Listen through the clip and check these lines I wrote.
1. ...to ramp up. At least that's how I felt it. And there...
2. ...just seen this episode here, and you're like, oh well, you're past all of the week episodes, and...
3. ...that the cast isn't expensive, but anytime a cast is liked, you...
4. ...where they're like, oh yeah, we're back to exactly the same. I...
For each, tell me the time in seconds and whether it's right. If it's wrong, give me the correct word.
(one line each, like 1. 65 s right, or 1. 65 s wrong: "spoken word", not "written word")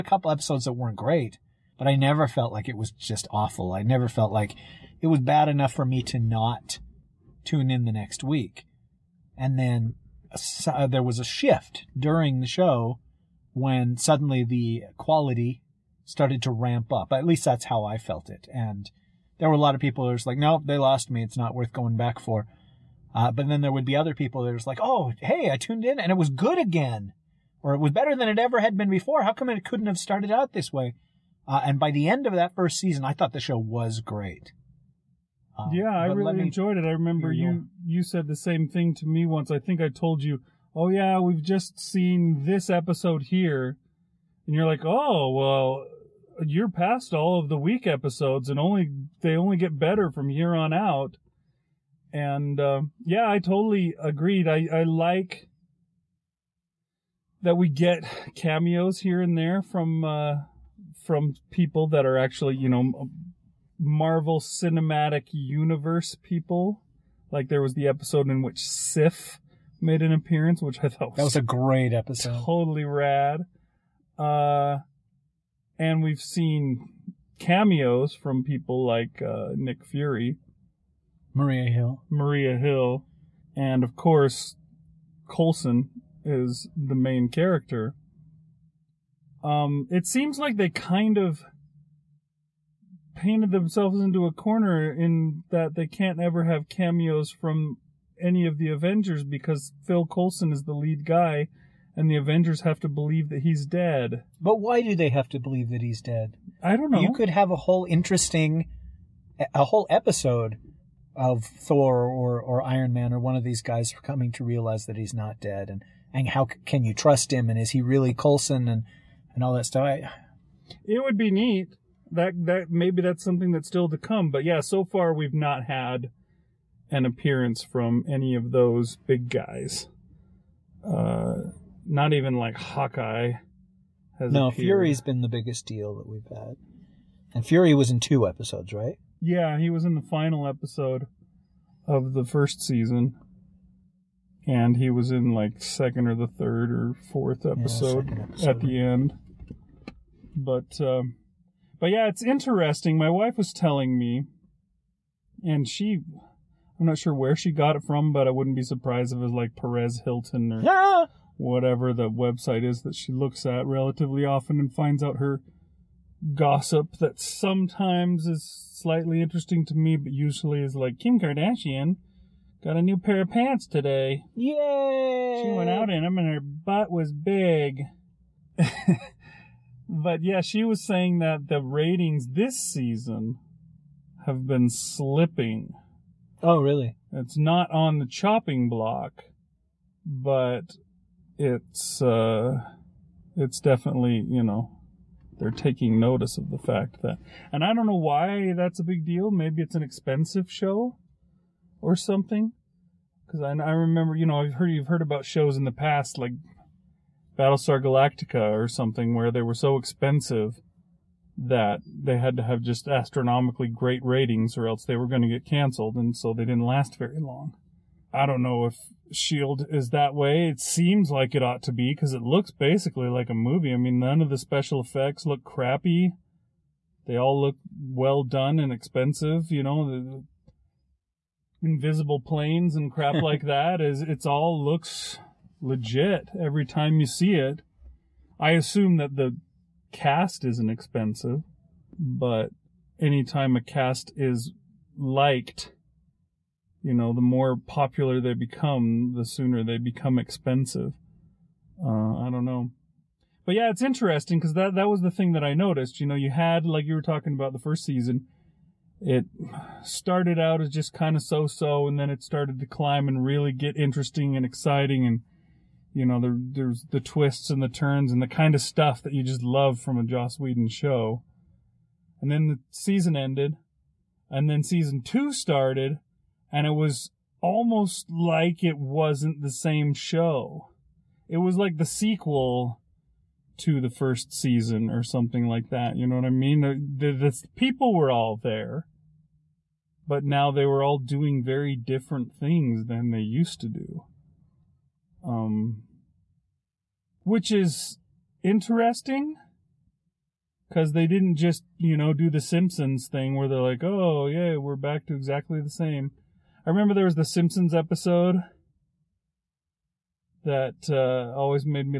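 1. 16 s right
2. 41 s right
3. 238 s right
4. 303 s right.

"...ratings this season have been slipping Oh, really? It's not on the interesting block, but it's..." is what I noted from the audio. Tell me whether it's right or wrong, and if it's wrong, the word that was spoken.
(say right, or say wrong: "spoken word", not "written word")
wrong: "chopping", not "interesting".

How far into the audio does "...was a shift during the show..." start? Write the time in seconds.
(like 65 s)
11 s.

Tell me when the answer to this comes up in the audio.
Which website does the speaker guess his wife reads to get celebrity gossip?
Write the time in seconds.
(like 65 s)
159 s.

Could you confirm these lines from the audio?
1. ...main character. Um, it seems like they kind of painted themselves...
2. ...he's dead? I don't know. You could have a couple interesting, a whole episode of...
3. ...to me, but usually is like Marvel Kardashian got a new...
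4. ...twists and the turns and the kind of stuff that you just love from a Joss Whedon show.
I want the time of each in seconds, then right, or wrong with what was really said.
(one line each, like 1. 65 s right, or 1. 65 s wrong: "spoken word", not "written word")
1. 86 s right
2. 105 s wrong: "whole", not "couple"
3. 169 s wrong: "Kim", not "Marvel"
4. 267 s right.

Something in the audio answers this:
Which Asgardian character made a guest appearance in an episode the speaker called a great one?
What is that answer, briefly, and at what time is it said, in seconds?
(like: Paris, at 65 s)
Sif, at 68 s.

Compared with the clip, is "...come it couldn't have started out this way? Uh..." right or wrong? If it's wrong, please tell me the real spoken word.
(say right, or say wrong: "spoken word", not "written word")
right.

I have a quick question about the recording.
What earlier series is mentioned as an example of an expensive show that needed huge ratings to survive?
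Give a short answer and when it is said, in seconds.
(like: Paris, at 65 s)
Battlestar Galactica, at 207 s.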